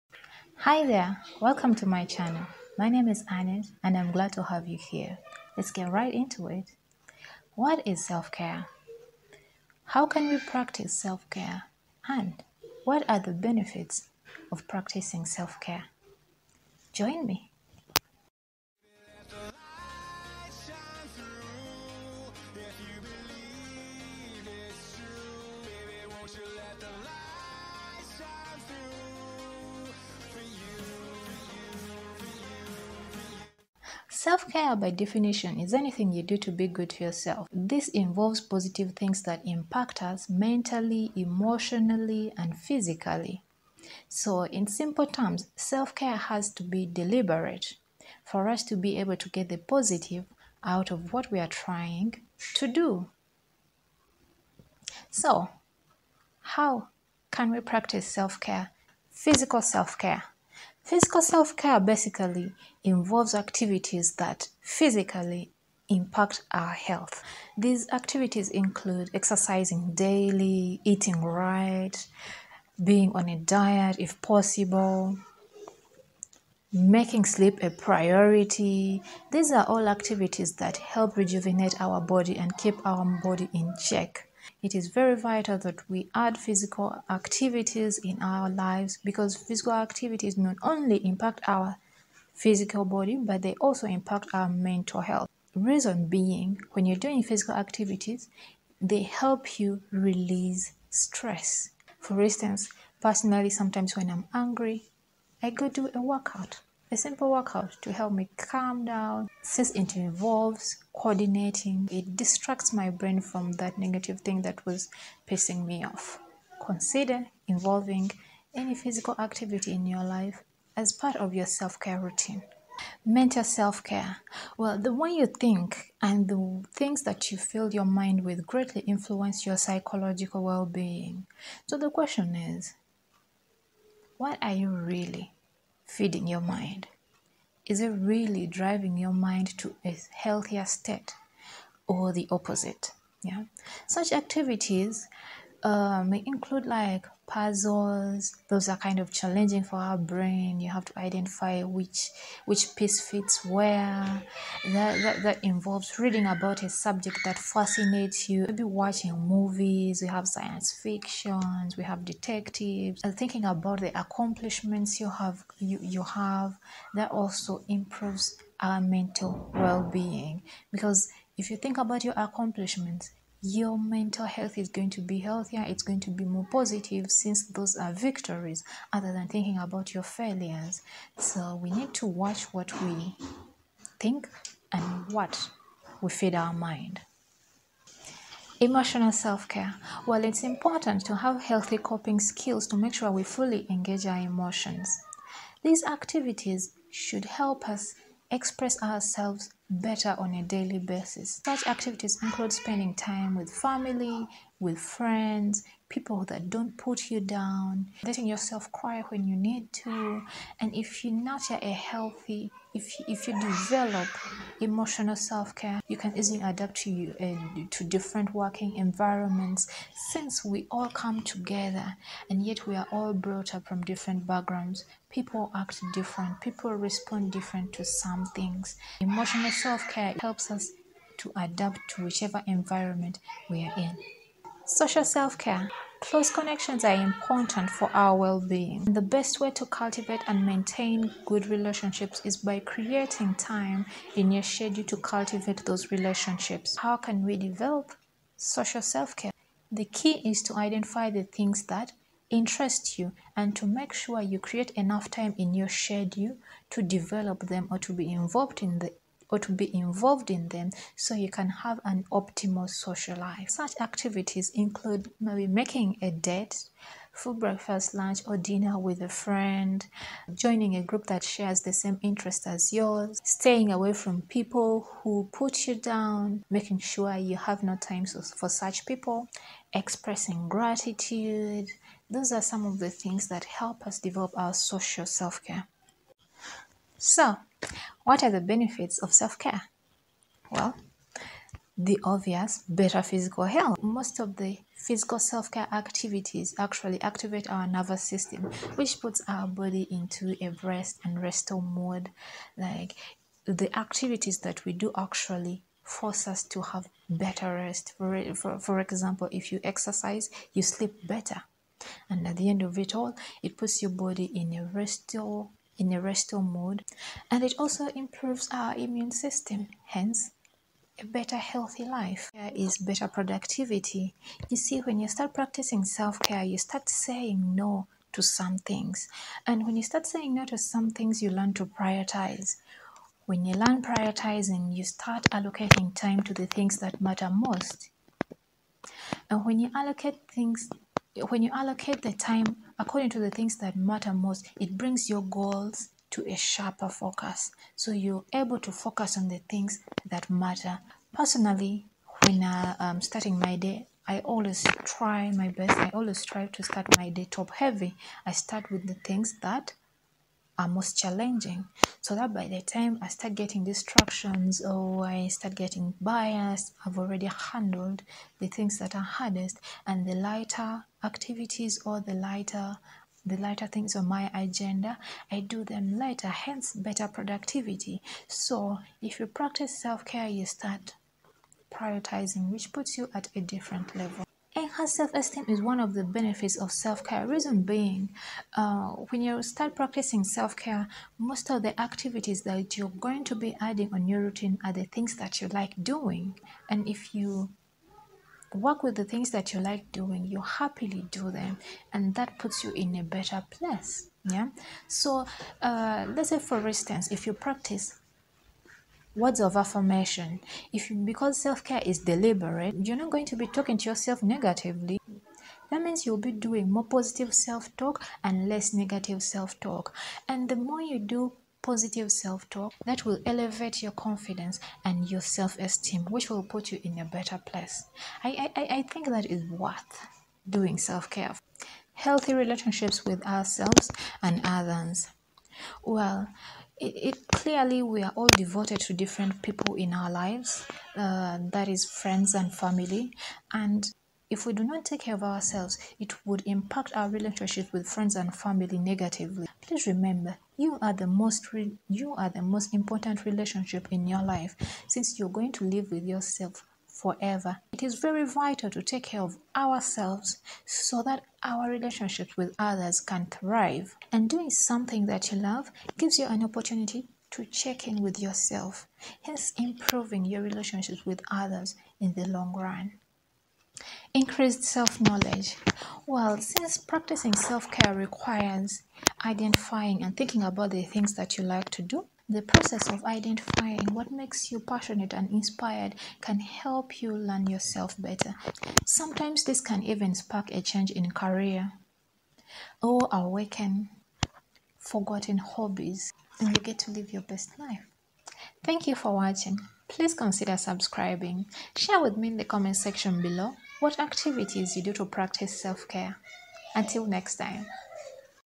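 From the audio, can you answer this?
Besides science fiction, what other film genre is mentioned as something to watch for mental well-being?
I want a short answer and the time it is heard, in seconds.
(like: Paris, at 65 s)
detectives, at 162 s.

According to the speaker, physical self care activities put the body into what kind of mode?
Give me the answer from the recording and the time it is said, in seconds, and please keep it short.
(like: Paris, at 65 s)
rest and restore, at 300 s.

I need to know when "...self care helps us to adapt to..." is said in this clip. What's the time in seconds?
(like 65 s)
229 s.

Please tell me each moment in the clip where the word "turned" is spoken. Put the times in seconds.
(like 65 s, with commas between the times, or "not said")
not said.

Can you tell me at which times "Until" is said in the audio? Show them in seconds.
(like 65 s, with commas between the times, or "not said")
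506 s.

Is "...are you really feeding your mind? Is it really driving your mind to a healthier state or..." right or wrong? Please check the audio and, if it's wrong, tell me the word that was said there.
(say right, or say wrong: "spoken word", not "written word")
right.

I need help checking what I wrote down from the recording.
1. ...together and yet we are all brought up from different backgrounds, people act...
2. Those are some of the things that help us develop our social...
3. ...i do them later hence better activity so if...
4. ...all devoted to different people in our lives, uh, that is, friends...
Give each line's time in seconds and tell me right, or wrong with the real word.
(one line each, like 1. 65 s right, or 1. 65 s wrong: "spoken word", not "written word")
1. 221 s right
2. 282 s right
3. 375 s wrong: "productivity", not "activity"
4. 438 s right.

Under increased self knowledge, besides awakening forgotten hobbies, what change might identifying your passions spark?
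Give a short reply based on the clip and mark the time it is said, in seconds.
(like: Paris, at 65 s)
a change in career, at 490 s.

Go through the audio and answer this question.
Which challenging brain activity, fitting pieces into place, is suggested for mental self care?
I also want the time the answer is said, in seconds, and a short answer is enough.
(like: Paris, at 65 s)
puzzles, at 147 s.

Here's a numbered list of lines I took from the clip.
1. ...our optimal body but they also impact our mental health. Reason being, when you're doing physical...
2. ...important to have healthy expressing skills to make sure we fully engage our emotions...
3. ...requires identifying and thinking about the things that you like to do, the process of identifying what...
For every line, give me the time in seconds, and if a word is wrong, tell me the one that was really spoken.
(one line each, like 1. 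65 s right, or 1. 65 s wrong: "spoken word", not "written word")
1. 91 s wrong: "physical", not "optimal"
2. 190 s wrong: "coping", not "expressing"
3. 477 s right.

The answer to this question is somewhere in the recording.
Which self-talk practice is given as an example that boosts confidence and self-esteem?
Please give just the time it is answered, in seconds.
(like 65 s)
409 s.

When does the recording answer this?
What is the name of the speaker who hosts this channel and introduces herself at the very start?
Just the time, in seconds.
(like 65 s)
3 s.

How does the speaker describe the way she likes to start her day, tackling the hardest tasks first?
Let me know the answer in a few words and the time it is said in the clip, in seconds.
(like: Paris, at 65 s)
top heavy, at 357 s.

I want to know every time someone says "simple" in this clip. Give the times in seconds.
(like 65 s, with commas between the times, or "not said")
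44 s, 106 s.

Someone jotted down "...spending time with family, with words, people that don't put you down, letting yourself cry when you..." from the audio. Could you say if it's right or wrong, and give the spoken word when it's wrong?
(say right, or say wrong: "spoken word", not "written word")
wrong: "friends", not "words".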